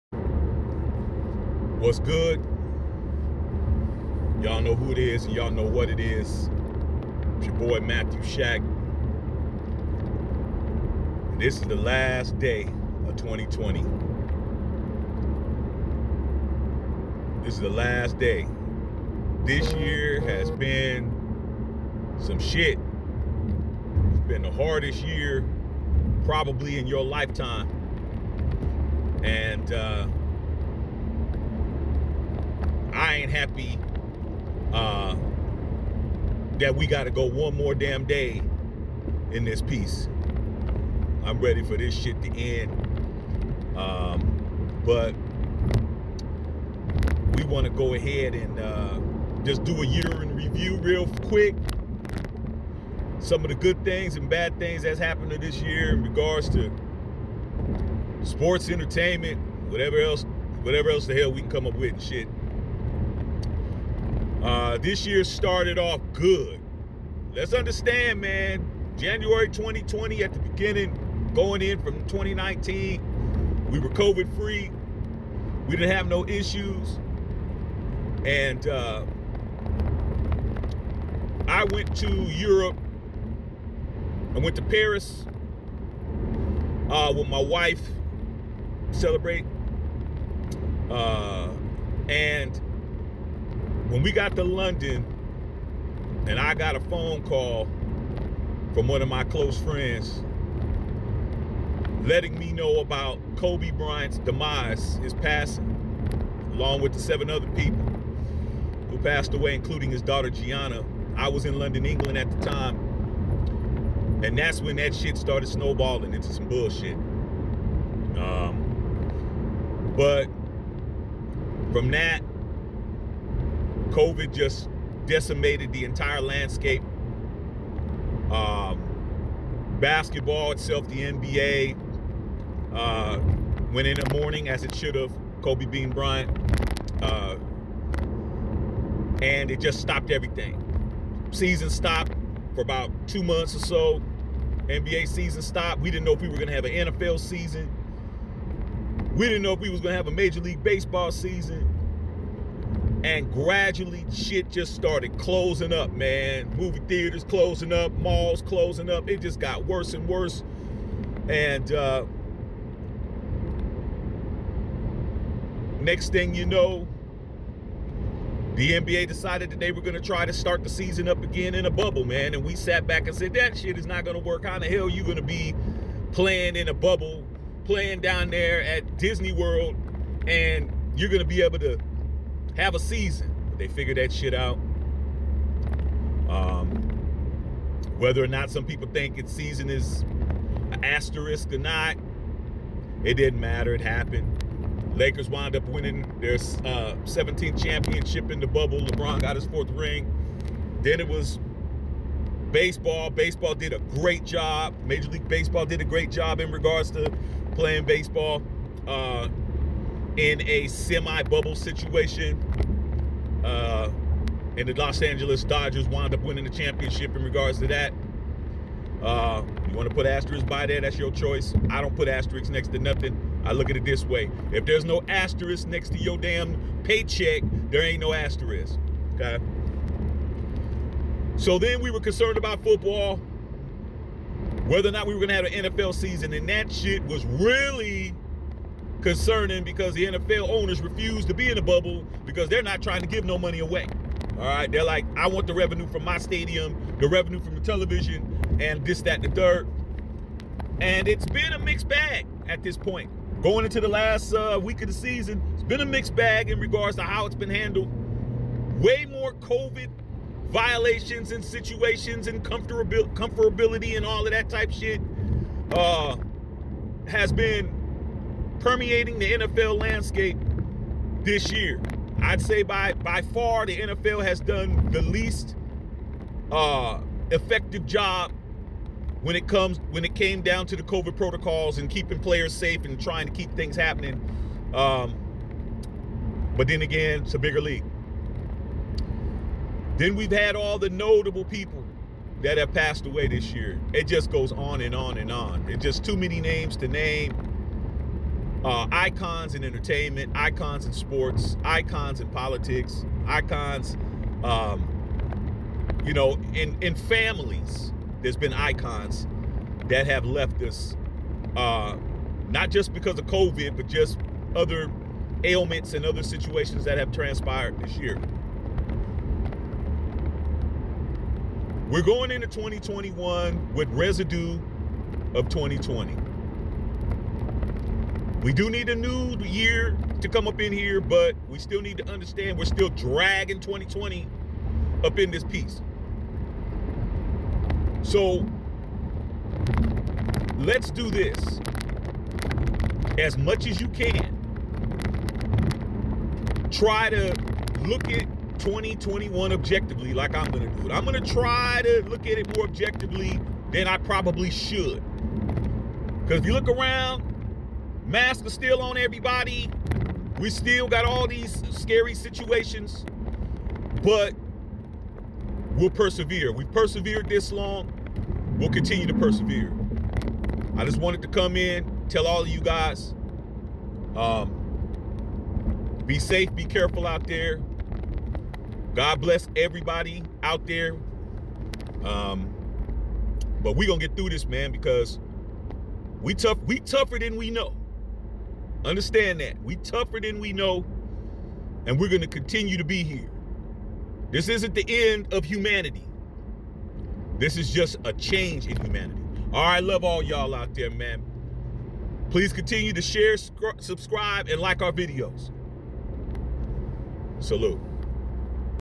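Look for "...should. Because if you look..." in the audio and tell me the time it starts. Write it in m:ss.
5:54.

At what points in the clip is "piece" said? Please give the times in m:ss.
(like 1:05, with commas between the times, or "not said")
0:39, 5:35.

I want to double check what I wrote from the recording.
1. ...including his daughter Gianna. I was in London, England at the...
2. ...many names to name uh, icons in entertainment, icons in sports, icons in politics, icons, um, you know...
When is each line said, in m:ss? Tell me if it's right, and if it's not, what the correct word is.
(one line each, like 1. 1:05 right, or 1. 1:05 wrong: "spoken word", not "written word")
1. 1:49 right
2. 4:56 right.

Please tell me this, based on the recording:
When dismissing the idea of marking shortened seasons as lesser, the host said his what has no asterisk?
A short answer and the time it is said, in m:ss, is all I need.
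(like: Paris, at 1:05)
Paycheck, at 3:46.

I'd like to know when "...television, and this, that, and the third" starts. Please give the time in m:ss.
4:07.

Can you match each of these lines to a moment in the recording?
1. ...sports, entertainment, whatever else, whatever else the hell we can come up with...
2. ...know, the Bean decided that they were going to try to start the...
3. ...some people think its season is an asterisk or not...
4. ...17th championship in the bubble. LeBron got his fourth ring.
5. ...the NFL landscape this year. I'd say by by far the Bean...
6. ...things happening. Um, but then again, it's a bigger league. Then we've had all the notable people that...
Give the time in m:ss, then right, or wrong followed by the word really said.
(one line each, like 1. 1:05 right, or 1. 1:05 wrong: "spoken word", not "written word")
1. 0:58 right
2. 2:46 wrong: "NBA", not "Bean"
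3. 3:08 right
4. 3:17 right
5. 4:29 wrong: "NFL", not "Bean"
6. 4:43 right.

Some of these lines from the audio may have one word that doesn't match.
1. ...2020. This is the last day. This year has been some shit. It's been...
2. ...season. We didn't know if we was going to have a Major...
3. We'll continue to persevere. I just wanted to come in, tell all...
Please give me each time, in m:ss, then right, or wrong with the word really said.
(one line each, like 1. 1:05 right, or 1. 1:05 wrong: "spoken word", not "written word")
1. 0:13 right
2. 2:27 right
3. 6:08 right.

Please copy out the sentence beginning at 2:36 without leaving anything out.
Movie theaters closing up, malls closing up.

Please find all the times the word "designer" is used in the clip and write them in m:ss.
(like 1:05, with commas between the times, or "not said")
not said.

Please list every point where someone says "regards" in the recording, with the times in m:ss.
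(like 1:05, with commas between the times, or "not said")
0:56, 3:26, 3:37, 4:16.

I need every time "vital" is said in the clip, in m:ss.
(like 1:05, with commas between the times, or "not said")
not said.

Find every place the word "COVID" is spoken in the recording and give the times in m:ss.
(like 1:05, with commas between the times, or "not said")
1:13, 2:03, 4:19, 4:40, 5:13.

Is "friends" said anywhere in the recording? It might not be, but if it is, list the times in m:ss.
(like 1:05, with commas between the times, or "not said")
1:39.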